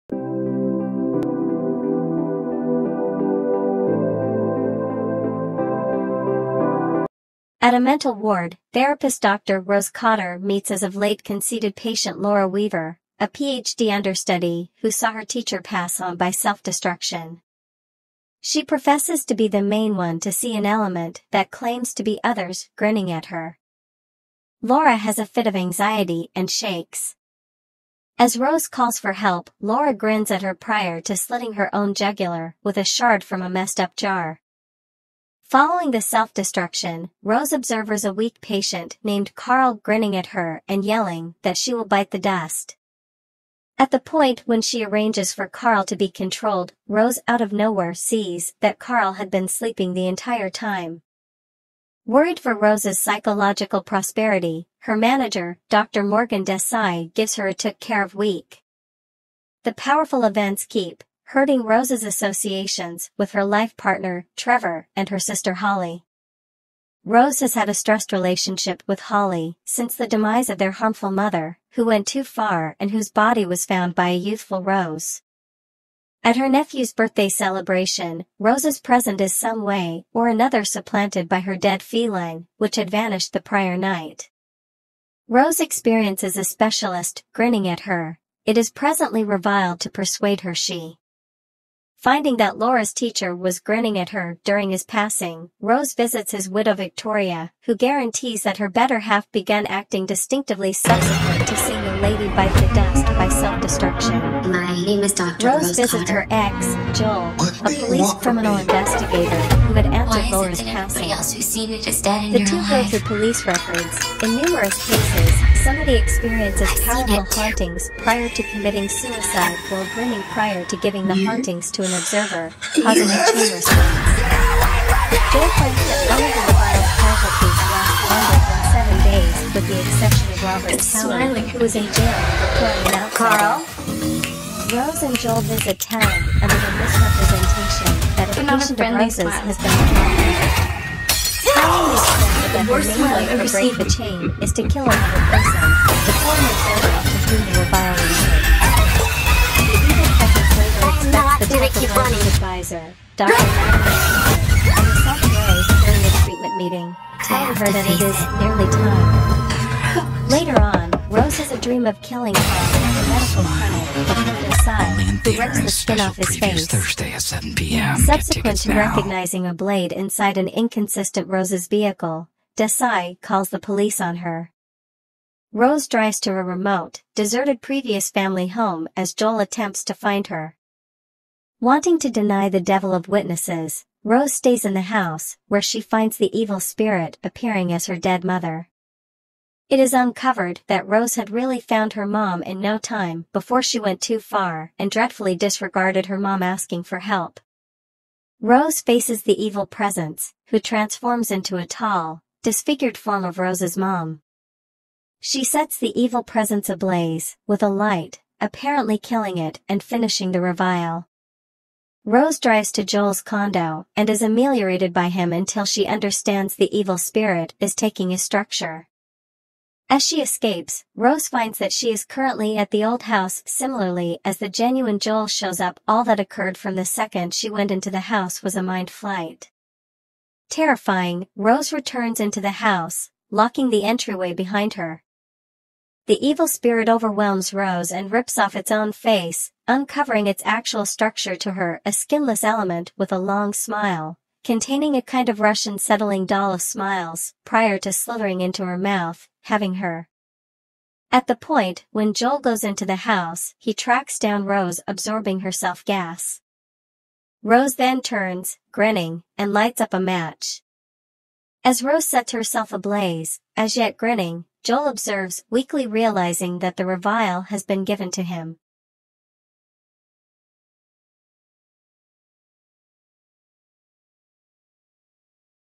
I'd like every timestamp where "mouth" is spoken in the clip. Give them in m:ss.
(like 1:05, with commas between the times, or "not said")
4:08.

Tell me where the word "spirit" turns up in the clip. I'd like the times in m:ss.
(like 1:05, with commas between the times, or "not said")
3:06, 3:36, 3:56.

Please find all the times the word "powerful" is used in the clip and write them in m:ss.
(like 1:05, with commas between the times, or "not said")
0:59, 1:56.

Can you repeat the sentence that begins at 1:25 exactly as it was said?
Rose experiences a specialist grinning at her.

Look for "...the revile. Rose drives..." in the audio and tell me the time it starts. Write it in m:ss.
3:30.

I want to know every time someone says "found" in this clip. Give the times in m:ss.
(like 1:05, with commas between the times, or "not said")
1:13, 3:11.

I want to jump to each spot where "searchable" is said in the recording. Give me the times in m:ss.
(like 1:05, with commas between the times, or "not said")
not said.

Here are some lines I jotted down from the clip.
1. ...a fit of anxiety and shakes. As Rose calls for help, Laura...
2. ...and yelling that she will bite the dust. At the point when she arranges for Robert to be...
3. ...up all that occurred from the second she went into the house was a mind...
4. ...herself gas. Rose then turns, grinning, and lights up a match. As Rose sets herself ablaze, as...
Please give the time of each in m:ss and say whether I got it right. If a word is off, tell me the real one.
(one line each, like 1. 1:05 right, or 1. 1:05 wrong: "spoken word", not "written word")
1. 0:25 right
2. 0:40 wrong: "Carl", not "Robert"
3. 3:45 right
4. 4:15 right.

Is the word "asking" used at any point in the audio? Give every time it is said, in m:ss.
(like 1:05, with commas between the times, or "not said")
3:16.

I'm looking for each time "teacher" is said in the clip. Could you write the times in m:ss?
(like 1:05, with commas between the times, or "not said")
0:15, 1:32.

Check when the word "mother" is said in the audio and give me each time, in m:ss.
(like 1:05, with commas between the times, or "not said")
1:11, 3:08.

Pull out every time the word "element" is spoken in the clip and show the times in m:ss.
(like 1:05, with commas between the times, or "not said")
0:20, 4:02.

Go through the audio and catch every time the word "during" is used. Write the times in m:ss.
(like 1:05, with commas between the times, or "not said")
1:34, 2:35.